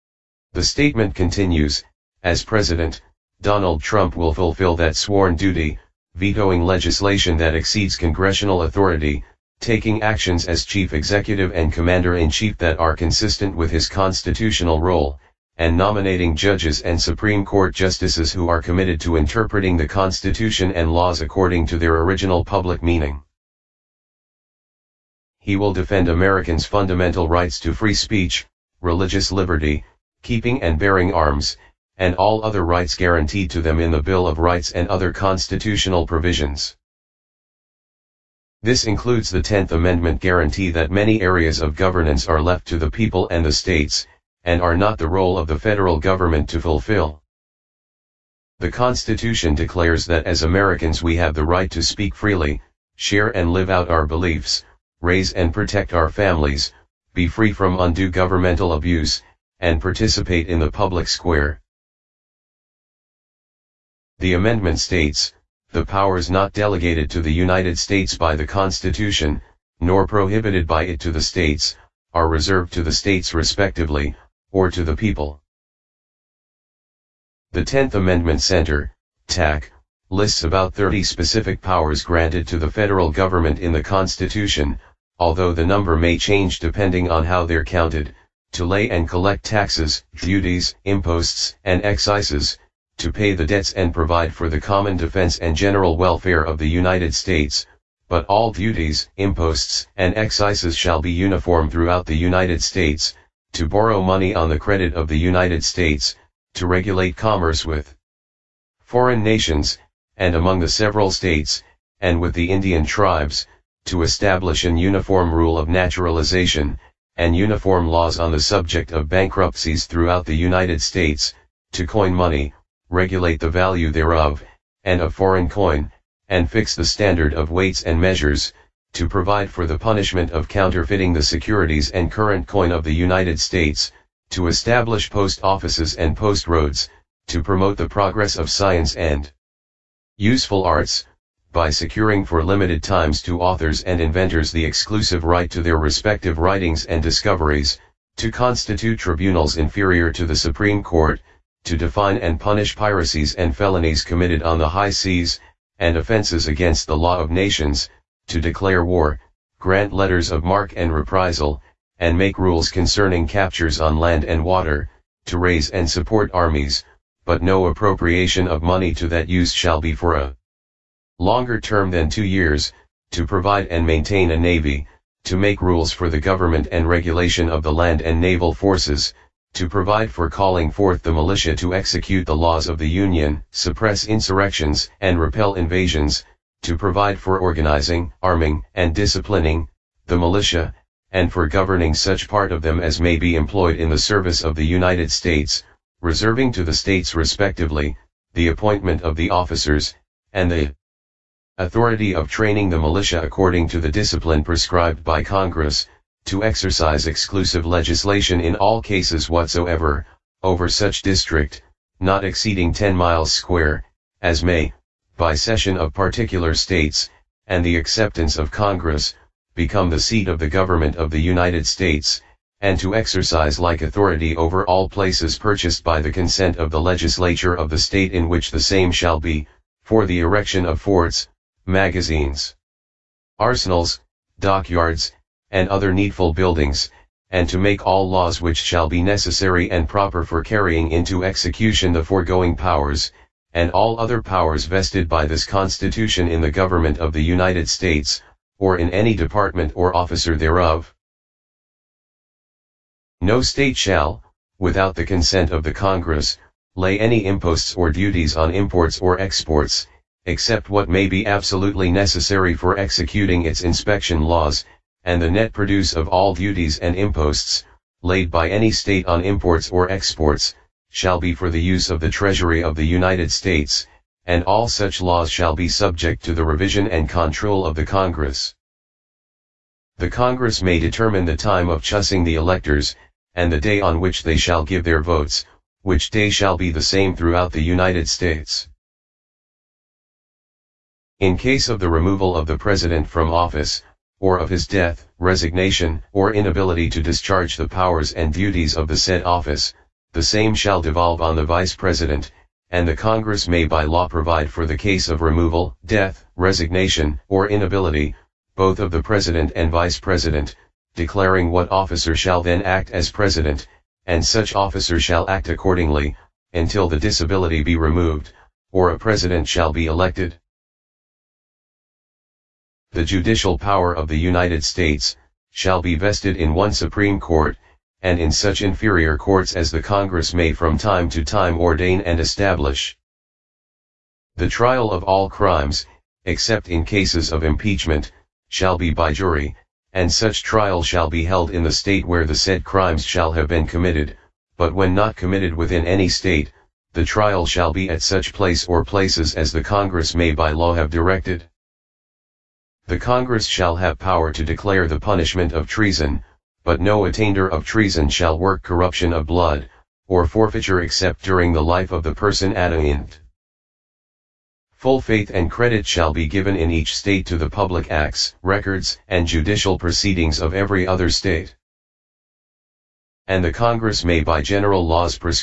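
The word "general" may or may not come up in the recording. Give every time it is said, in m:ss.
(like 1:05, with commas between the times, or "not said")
1:35, 6:14.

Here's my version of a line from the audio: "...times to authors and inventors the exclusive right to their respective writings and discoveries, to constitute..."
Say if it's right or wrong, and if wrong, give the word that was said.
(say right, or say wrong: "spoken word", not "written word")
right.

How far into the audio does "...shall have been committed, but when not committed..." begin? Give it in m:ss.
5:43.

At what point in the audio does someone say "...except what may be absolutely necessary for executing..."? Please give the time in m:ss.
4:20.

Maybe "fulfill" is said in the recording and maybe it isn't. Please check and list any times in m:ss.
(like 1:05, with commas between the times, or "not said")
0:04, 0:46.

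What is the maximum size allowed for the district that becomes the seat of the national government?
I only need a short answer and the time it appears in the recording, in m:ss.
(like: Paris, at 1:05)
10 miles square, at 3:32.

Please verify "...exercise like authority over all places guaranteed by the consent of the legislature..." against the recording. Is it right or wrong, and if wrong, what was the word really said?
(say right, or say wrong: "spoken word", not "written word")
wrong: "purchased", not "guaranteed".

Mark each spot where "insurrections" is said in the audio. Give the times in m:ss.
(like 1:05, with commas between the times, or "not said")
3:04.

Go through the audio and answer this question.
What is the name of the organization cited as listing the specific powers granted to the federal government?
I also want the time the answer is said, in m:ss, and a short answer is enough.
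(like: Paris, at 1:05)
Tenth Amendment Center, at 1:17.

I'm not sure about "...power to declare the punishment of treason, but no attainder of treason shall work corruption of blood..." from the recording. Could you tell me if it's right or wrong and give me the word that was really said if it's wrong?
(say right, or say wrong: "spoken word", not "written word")
right.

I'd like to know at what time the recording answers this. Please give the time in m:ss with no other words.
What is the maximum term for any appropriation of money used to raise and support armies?
2:52.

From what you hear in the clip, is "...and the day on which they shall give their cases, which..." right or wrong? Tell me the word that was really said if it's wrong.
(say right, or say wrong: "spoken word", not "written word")
wrong: "votes", not "cases".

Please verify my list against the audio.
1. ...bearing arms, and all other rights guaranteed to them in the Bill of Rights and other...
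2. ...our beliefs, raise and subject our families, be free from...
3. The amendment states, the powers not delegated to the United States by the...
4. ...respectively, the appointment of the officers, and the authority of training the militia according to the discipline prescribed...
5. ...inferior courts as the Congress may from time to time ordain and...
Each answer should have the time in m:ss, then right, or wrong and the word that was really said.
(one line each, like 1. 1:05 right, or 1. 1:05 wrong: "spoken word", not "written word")
1. 0:30 right
2. 0:53 wrong: "protect", not "subject"
3. 1:04 right
4. 3:17 right
5. 5:28 right.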